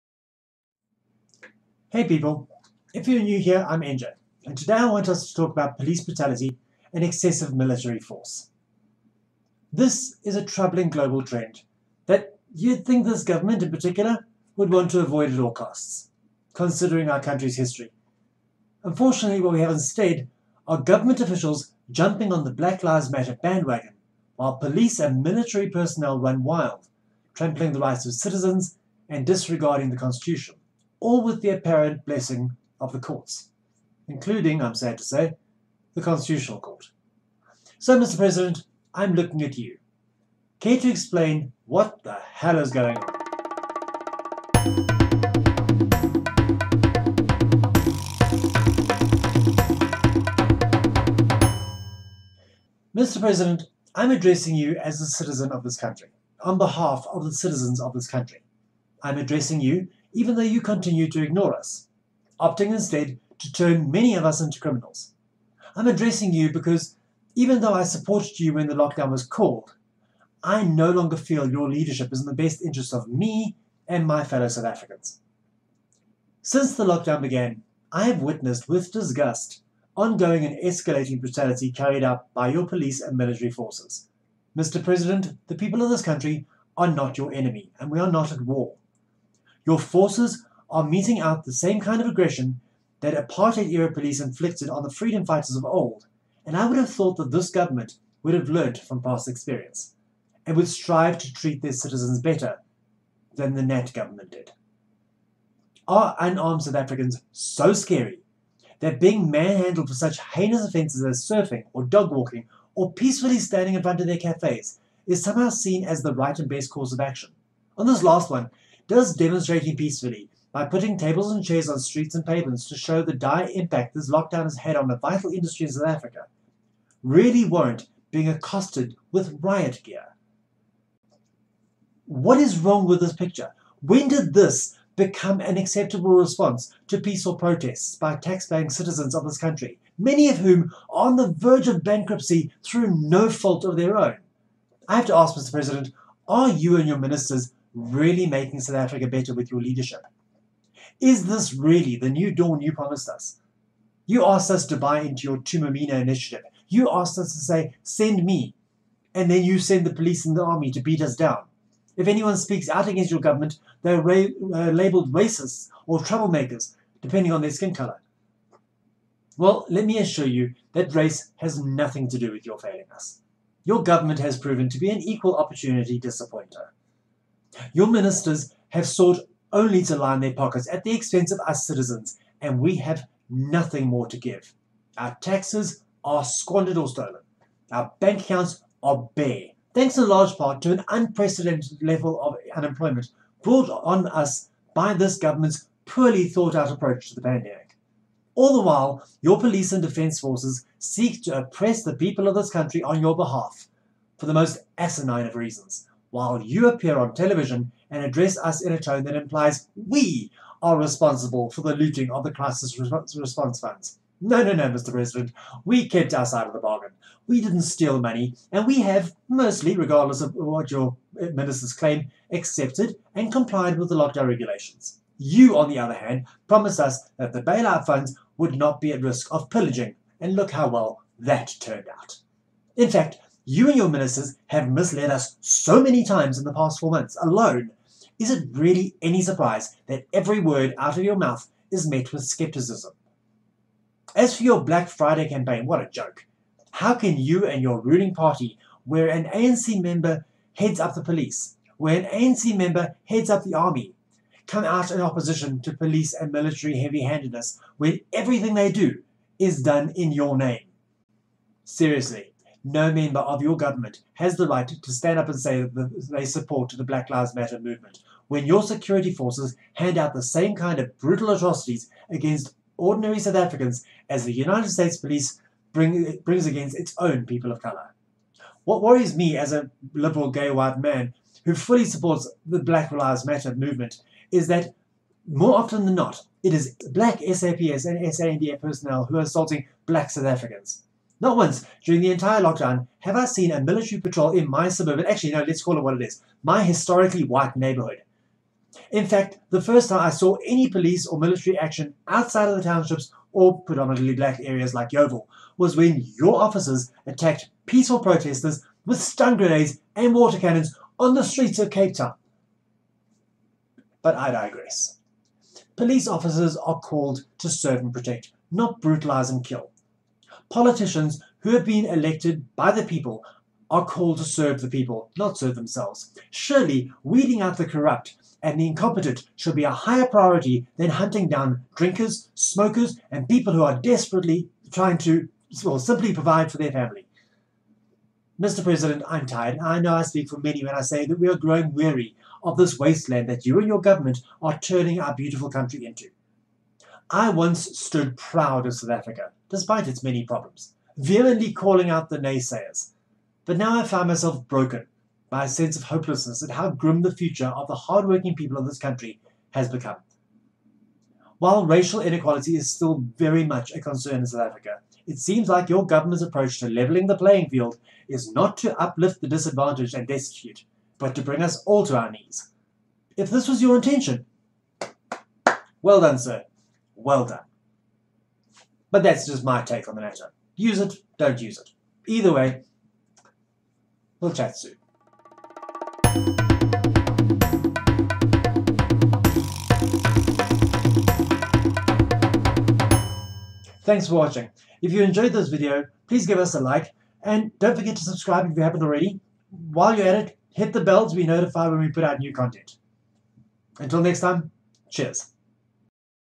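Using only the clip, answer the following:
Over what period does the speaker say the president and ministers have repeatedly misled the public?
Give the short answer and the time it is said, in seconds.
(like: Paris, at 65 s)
past four months, at 236 s.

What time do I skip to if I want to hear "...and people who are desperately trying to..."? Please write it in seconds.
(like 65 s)
333 s.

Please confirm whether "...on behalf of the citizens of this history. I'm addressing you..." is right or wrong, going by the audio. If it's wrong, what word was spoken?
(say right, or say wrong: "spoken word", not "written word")
wrong: "country", not "history".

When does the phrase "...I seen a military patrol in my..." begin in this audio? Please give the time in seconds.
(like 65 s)
293 s.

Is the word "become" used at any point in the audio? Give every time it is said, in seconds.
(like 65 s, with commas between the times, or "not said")
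134 s, 359 s.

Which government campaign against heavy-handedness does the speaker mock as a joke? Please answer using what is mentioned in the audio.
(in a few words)
Black Friday.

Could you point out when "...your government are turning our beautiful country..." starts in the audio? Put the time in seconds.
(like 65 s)
343 s.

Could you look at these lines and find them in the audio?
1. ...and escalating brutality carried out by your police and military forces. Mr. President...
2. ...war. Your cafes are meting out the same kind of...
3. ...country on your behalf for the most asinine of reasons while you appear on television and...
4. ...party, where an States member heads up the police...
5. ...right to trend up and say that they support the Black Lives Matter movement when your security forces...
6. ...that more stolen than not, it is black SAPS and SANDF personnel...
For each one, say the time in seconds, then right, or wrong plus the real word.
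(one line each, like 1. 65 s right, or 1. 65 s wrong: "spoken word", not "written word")
1. 80 s right
2. 88 s wrong: "forces", not "cafes"
3. 202 s right
4. 248 s wrong: "ANC", not "States"
5. 264 s wrong: "stand", not "trend"
6. 284 s wrong: "often", not "stolen".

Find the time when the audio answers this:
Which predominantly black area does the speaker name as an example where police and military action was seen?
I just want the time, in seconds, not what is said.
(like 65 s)
304 s.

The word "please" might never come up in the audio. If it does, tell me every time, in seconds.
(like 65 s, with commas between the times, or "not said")
396 s.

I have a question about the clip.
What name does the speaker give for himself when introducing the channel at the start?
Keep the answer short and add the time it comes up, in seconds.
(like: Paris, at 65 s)
NJ, at 3 s.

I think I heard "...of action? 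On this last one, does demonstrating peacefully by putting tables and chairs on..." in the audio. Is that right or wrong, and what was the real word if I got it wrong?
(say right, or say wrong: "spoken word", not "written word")
right.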